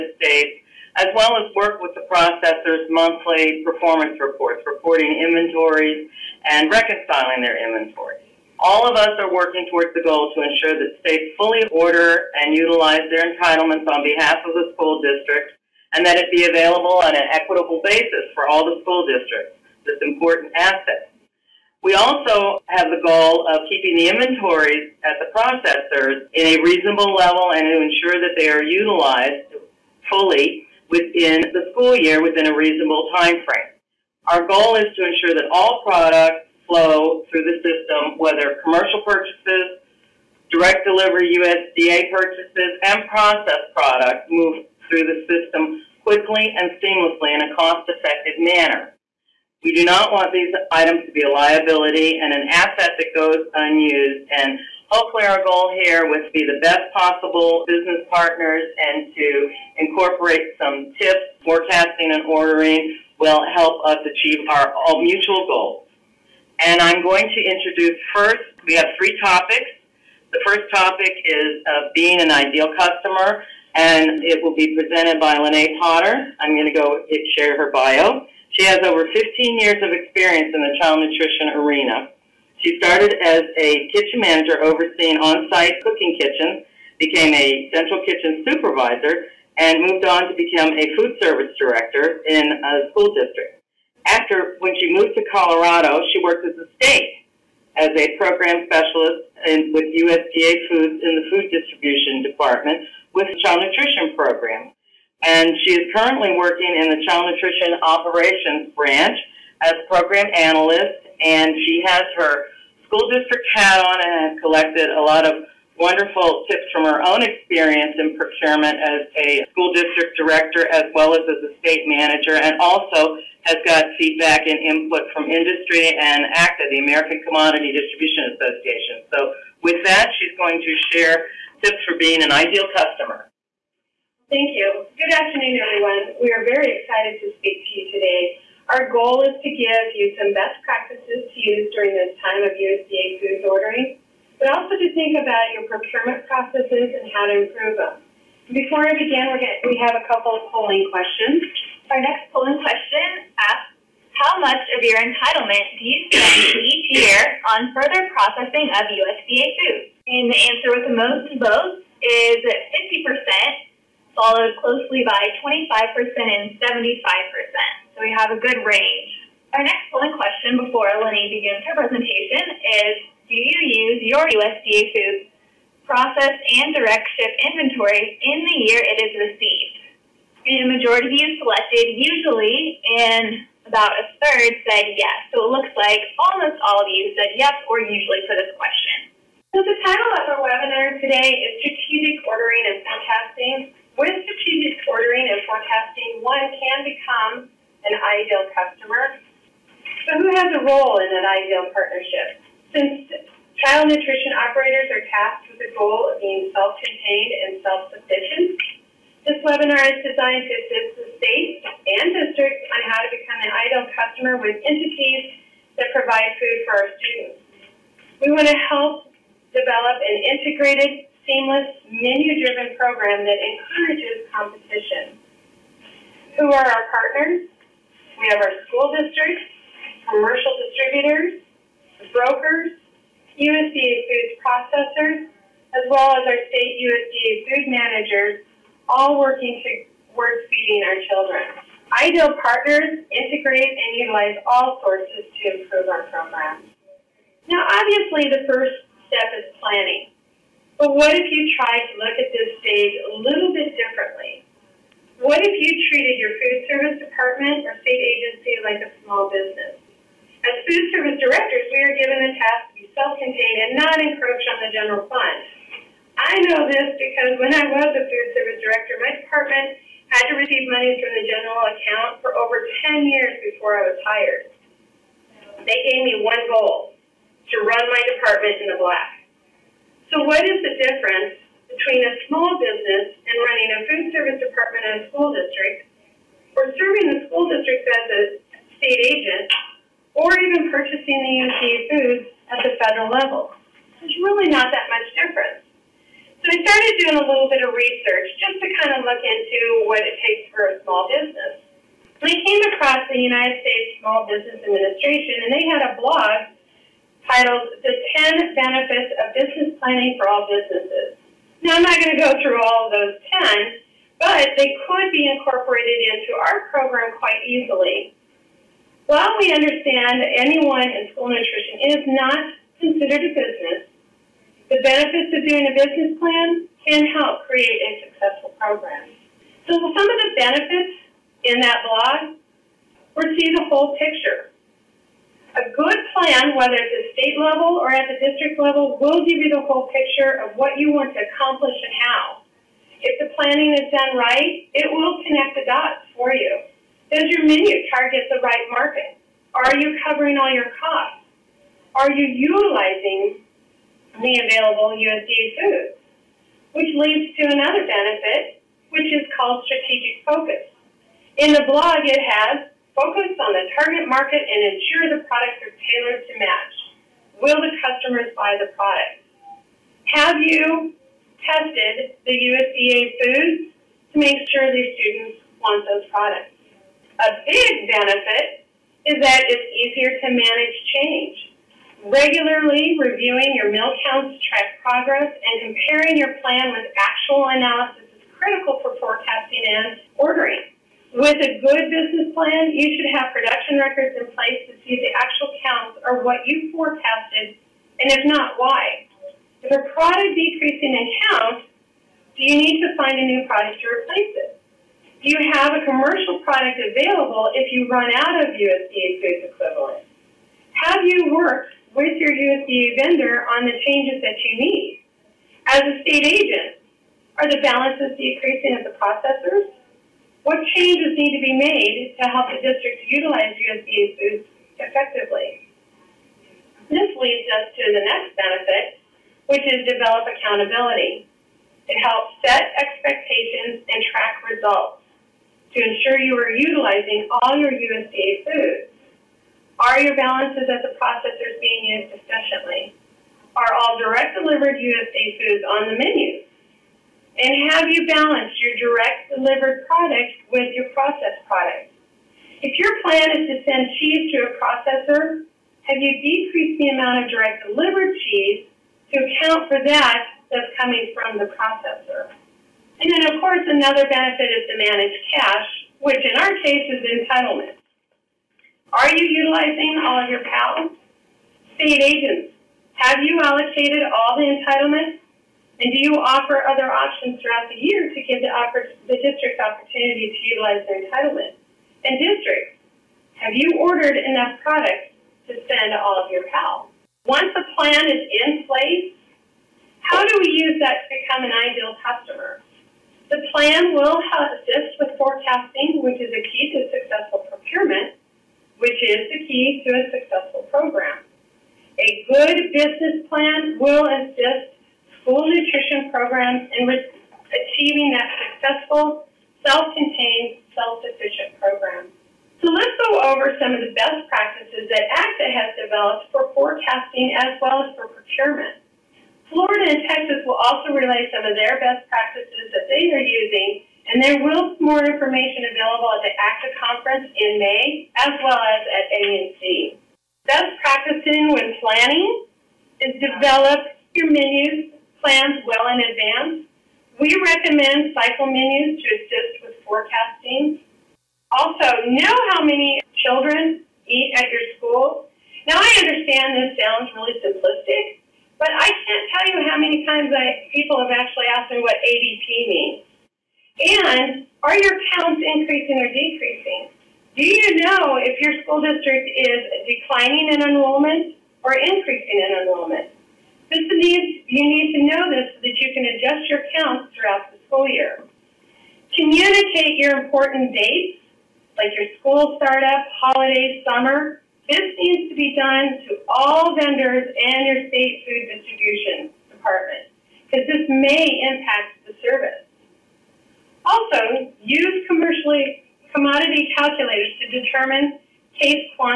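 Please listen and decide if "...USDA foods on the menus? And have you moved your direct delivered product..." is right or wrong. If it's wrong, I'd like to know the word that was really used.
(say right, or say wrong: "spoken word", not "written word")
wrong: "balanced", not "moved".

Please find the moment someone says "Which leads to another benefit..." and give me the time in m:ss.
5:56.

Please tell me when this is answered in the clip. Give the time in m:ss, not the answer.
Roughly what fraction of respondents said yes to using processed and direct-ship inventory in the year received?
3:03.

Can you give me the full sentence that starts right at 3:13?
With strategic ordering and forecasting, one can become an ideal customer.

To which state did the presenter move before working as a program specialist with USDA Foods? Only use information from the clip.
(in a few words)
Colorado.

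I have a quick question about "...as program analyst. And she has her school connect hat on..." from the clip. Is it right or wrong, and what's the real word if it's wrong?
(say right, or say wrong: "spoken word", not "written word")
wrong: "district", not "connect".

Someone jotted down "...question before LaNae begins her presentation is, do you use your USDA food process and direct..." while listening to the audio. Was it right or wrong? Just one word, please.
right.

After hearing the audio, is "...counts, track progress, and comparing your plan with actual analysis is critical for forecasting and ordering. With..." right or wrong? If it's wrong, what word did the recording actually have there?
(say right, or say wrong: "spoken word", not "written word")
right.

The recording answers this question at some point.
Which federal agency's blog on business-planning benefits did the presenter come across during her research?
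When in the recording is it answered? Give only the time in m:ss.
5:03.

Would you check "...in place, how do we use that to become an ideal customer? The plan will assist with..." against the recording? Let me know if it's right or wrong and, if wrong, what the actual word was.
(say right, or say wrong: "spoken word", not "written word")
right.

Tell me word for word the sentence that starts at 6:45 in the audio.
Do you have a commercial product available if you run out of USDA food equivalent?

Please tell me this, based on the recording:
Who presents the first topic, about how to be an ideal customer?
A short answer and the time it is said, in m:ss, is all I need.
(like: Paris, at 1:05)
LaNae Potter, at 1:15.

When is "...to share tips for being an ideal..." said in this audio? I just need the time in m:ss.
2:10.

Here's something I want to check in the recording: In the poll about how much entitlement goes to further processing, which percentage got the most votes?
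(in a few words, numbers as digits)
50%.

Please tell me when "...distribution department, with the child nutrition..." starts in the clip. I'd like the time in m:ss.
1:41.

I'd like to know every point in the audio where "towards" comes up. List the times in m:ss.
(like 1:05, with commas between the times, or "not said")
0:09, 4:00.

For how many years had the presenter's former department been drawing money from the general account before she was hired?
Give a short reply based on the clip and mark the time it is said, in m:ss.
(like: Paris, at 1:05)
10, at 4:32.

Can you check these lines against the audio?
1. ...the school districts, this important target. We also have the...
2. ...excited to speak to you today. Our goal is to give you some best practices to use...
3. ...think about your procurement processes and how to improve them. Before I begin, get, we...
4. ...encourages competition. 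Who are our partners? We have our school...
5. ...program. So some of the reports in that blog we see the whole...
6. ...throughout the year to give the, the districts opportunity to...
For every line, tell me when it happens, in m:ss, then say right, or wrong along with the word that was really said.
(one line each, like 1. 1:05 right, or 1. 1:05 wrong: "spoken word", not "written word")
1. 0:18 wrong: "asset", not "target"
2. 2:16 right
3. 2:24 right
4. 3:43 right
5. 5:28 wrong: "benefits", not "reports"
6. 7:57 right.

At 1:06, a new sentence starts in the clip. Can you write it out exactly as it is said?
And I'm going to introduce first, we have three topics.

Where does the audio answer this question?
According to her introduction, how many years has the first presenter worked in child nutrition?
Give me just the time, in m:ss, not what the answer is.
1:19.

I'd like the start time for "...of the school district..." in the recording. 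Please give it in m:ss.
0:14.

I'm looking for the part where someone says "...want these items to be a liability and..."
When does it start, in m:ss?
0:50.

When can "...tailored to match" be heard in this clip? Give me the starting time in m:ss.
6:05.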